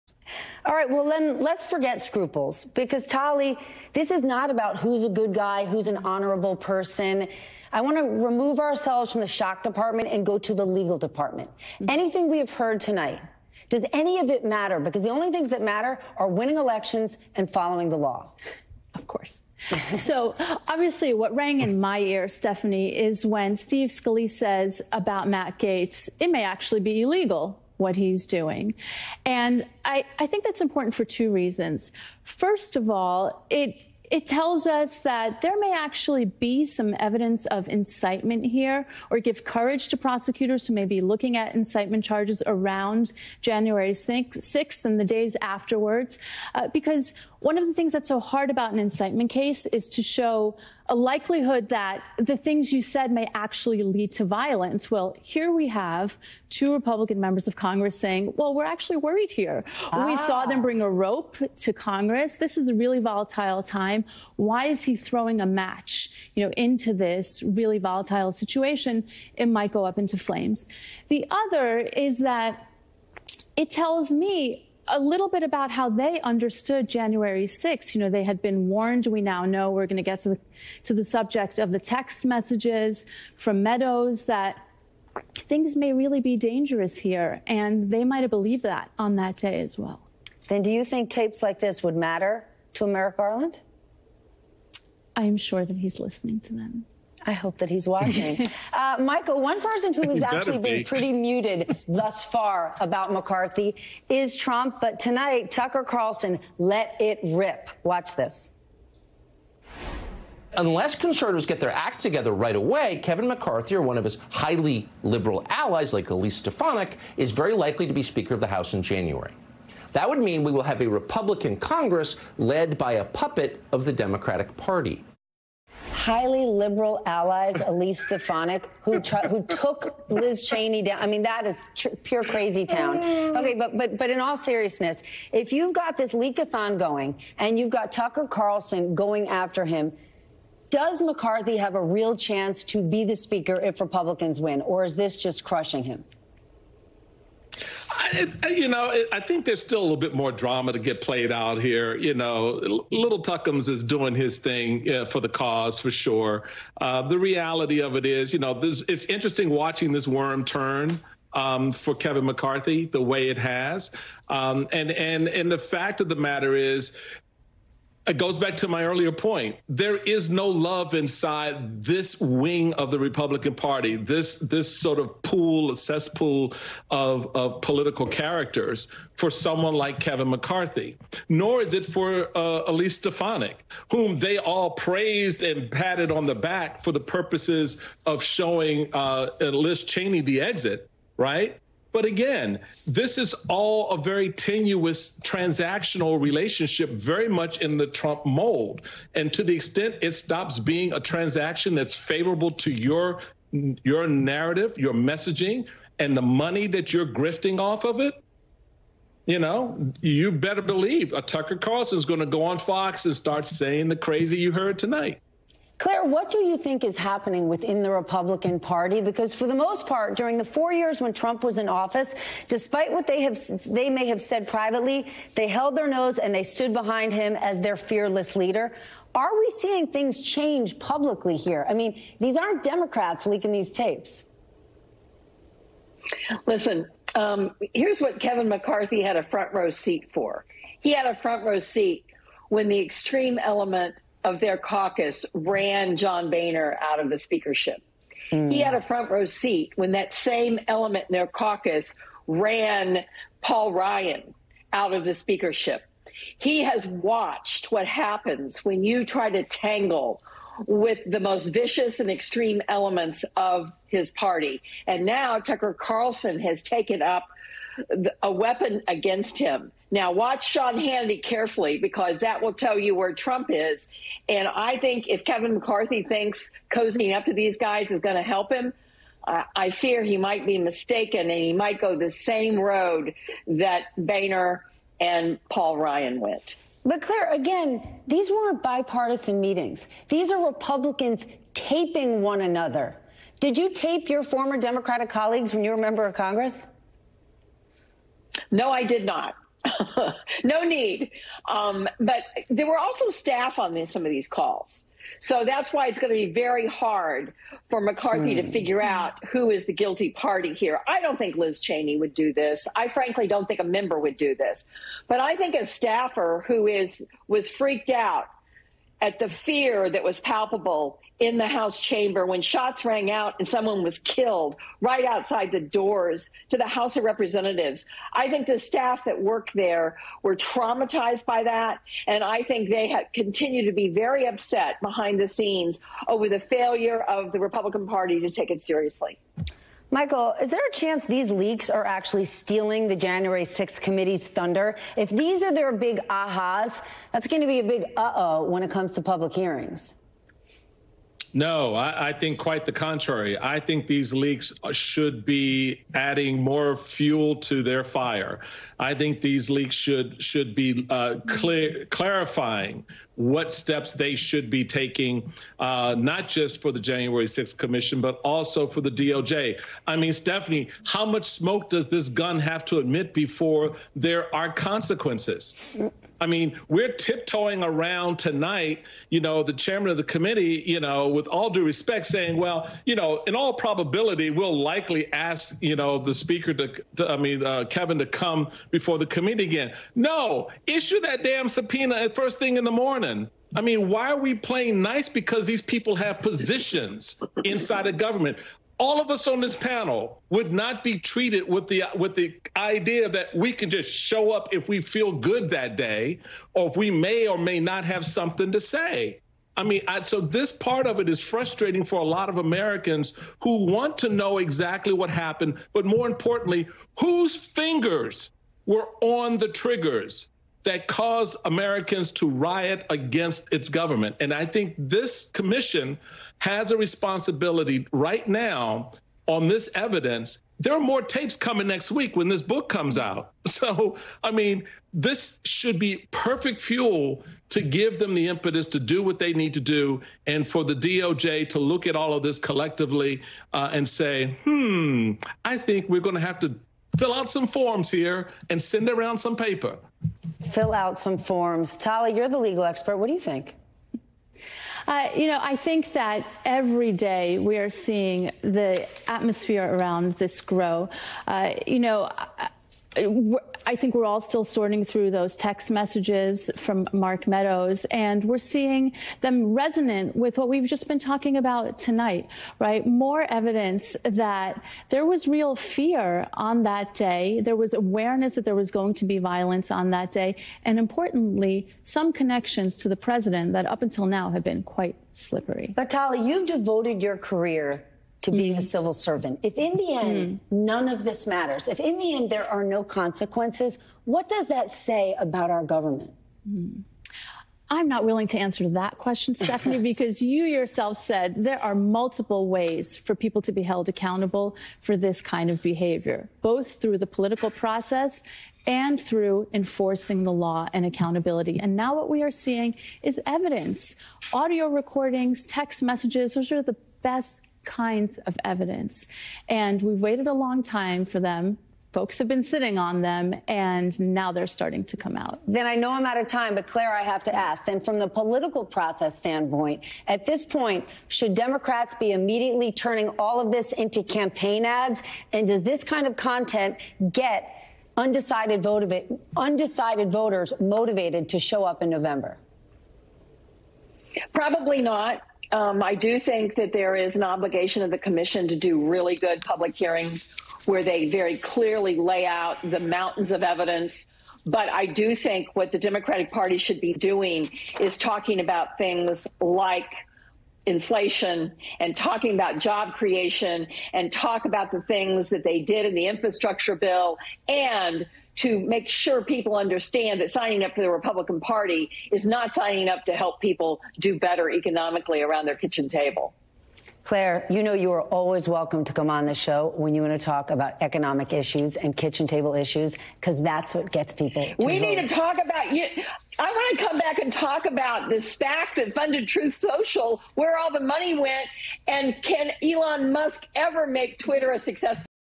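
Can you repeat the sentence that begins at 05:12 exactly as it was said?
I frankly don't think a member would do this.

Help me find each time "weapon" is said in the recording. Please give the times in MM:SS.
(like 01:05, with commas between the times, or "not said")
04:28.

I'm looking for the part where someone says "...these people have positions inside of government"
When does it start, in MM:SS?
06:35.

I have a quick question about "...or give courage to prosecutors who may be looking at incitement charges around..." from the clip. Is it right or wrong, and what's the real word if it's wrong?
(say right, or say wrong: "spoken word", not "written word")
right.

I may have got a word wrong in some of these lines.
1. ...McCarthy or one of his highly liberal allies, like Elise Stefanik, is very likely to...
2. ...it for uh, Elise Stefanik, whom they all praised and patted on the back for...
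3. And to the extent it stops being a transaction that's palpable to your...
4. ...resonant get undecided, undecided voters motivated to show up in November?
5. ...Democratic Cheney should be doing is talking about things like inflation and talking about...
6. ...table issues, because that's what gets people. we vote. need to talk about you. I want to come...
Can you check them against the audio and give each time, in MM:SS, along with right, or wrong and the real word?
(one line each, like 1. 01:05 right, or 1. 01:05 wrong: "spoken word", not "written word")
1. 01:53 right
2. 03:01 right
3. 03:19 wrong: "favorable", not "palpable"
4. 08:56 wrong: "content", not "resonant"
5. 09:15 wrong: "Party", not "Cheney"
6. 09:42 right.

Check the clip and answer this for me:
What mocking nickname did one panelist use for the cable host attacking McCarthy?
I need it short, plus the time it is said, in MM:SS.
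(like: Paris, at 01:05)
Little Tuckums, at 02:32.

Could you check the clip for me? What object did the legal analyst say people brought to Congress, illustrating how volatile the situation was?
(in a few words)
A rope.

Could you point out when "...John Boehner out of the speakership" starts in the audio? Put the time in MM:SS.
04:05.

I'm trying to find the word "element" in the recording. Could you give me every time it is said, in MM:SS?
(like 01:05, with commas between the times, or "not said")
04:03, 04:10, 04:22.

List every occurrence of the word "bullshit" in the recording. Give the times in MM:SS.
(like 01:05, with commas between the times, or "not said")
not said.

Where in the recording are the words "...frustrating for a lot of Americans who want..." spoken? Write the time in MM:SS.
06:51.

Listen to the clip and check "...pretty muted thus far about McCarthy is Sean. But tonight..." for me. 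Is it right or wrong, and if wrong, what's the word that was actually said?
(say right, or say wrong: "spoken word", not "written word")
wrong: "Trump", not "Sean".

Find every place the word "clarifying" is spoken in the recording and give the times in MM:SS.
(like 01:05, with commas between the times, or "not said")
06:01.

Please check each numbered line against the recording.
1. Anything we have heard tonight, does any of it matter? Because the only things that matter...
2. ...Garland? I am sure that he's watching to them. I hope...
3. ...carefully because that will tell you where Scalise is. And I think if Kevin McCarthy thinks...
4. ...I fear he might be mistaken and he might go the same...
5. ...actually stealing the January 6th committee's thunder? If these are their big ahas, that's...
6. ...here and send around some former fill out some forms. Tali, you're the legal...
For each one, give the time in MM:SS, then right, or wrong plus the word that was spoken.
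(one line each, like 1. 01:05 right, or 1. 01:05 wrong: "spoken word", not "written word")
1. 00:11 right
2. 01:33 wrong: "listening", not "watching"
3. 04:31 wrong: "Trump", not "Scalise"
4. 04:39 right
5. 05:41 right
6. 07:27 wrong: "paper", not "former".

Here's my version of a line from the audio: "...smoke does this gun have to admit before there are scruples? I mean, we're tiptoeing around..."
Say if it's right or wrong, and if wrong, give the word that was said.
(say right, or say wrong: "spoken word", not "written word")
wrong: "consequences", not "scruples".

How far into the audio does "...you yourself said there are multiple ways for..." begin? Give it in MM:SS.
08:20.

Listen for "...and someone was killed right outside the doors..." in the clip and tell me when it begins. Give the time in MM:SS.
05:23.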